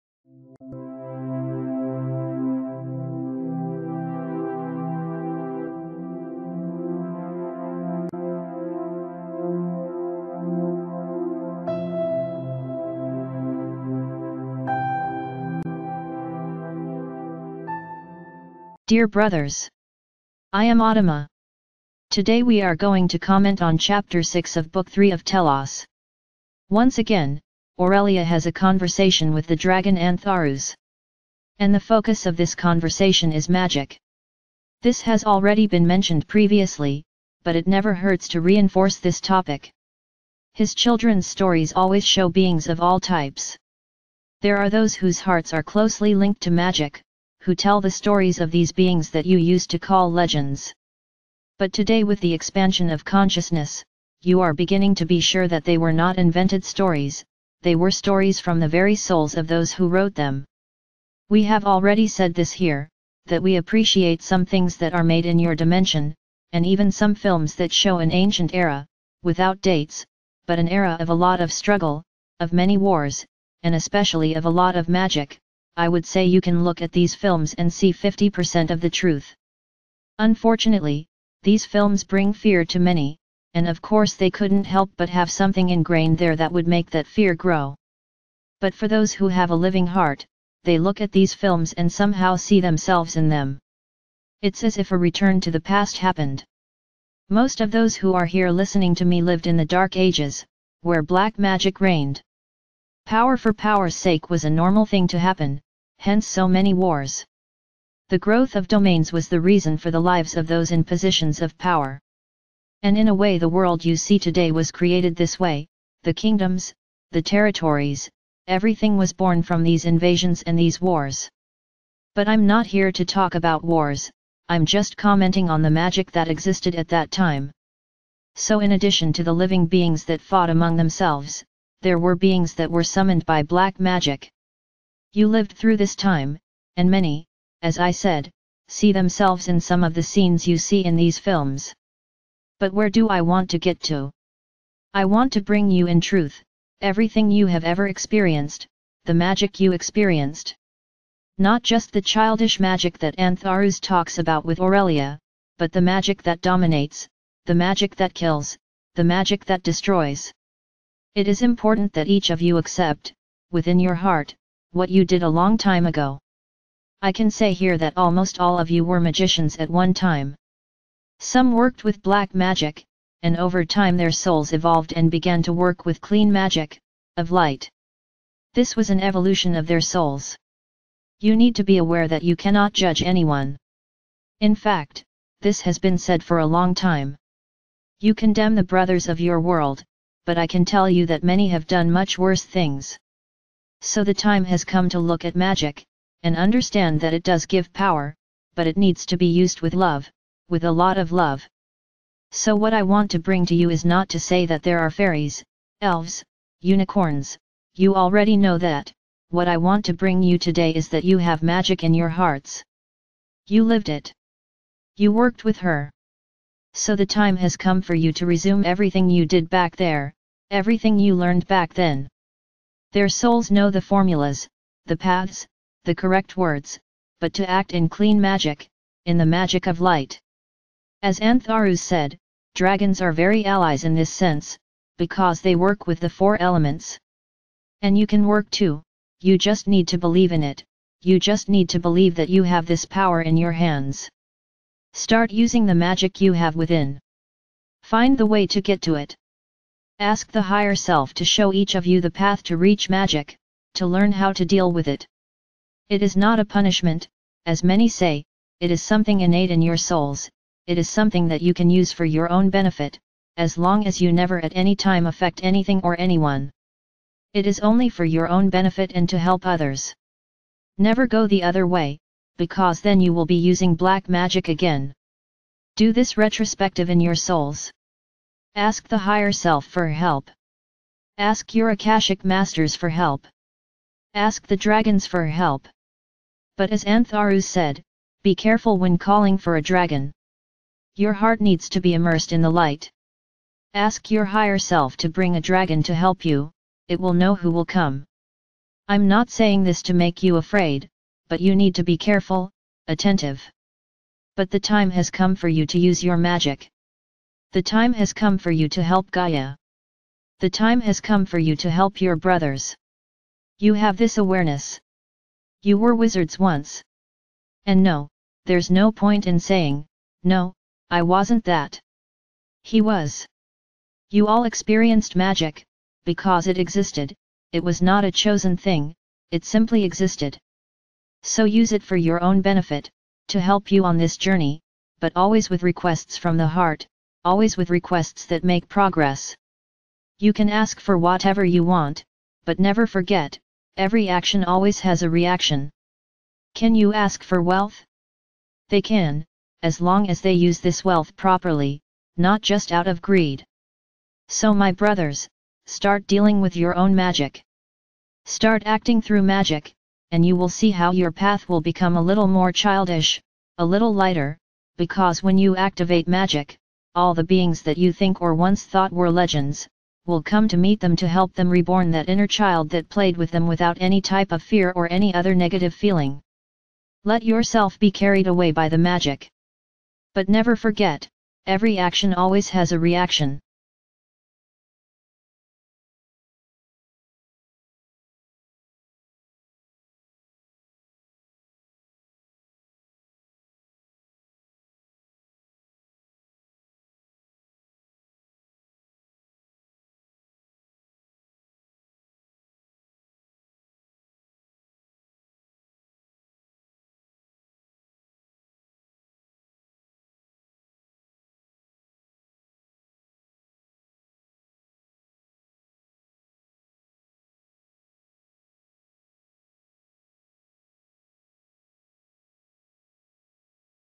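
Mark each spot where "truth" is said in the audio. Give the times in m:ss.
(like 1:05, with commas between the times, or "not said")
1:18, 2:26.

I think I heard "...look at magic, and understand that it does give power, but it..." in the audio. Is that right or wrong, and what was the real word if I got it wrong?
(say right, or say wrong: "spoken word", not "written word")
right.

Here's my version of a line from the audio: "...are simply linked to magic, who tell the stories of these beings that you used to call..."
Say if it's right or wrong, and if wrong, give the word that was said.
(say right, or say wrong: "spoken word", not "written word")
wrong: "closely", not "simply".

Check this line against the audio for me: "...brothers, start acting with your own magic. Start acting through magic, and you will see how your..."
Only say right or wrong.
wrong.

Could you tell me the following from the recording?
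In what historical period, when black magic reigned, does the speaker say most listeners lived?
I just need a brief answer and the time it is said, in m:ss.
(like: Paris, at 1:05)
Dark Ages, at 1:39.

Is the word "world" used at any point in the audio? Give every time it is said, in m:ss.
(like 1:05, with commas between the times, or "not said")
1:53, 3:09.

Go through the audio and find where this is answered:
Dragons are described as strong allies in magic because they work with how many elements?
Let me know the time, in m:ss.
3:56.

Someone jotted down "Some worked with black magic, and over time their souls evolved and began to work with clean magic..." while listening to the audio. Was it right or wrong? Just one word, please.
right.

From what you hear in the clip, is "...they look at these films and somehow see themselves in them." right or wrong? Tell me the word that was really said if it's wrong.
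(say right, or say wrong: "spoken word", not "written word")
right.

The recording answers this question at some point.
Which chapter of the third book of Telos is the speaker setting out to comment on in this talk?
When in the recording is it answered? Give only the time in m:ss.
0:23.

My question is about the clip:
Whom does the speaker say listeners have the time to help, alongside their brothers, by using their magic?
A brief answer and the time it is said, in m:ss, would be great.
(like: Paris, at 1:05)
Gaia, at 5:09.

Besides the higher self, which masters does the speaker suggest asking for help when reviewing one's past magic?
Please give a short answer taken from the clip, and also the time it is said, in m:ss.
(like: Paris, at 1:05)
Akashic masters, at 4:41.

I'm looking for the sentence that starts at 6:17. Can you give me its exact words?
Let yourself be carried away by the magic.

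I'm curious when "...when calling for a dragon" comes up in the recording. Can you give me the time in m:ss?
4:48.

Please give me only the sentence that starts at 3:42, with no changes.
Their souls know the formulas, the paths, the correct words, but to act in clean magic, in the magic of light.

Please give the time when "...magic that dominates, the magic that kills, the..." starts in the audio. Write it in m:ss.
2:35.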